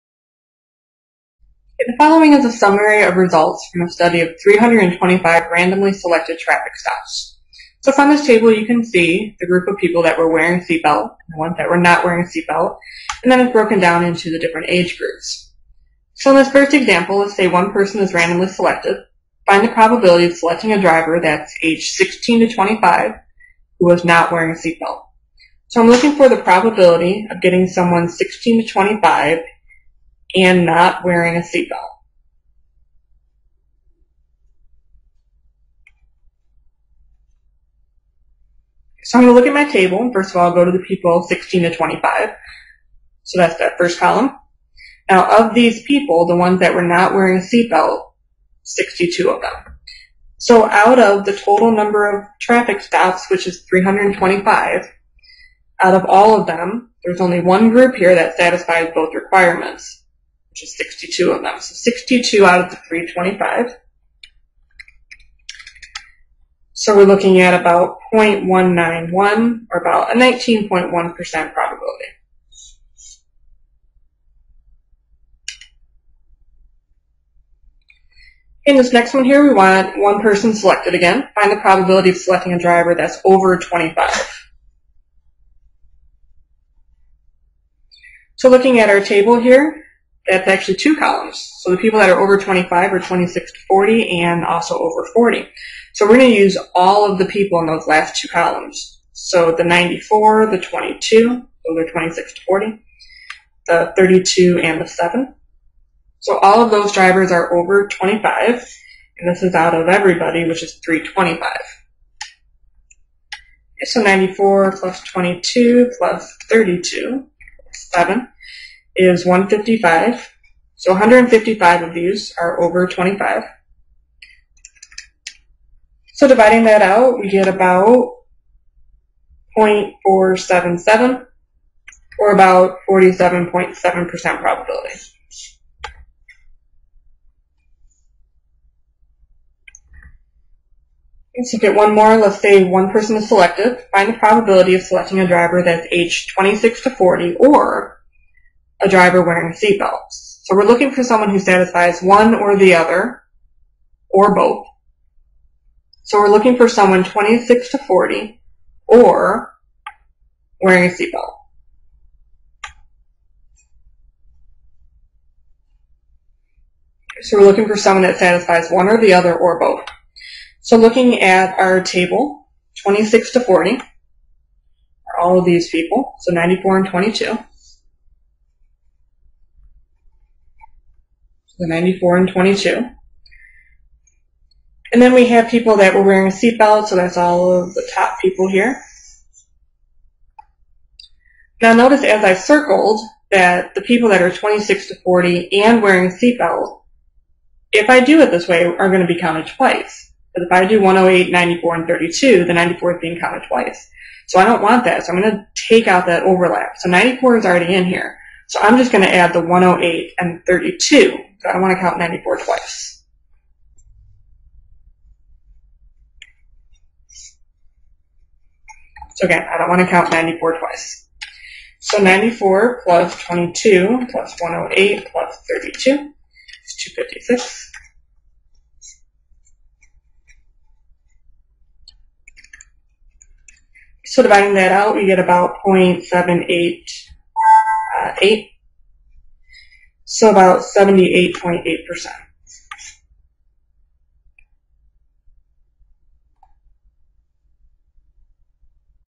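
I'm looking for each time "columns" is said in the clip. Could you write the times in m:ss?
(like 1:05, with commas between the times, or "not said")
0:43, 1:30, 1:38.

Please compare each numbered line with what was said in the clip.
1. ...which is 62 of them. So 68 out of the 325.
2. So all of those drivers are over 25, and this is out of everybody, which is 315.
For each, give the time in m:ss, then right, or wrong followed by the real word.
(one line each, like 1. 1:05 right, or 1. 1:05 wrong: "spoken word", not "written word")
1. 1:00 wrong: "62", not "68"
2. 1:46 wrong: "325", not "315".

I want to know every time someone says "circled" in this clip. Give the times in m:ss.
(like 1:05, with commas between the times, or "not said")
3:12.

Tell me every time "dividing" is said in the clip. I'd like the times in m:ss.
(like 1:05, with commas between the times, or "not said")
2:06, 3:54.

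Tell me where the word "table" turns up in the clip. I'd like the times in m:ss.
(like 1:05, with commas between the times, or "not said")
0:08, 0:39, 1:28, 2:51.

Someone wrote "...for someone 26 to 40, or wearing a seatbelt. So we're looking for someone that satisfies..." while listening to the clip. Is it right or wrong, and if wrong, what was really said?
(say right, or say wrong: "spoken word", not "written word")
right.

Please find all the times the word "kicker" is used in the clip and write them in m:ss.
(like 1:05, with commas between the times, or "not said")
not said.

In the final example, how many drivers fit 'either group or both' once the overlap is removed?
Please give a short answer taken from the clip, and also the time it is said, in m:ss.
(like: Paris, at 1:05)
256, at 3:46.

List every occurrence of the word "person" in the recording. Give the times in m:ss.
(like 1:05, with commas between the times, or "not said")
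0:17, 1:20, 2:22.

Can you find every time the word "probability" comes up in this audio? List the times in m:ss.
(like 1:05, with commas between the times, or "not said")
0:19, 0:26, 1:10, 1:21, 2:14, 2:24.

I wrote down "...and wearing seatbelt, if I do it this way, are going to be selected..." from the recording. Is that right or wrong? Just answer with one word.
wrong.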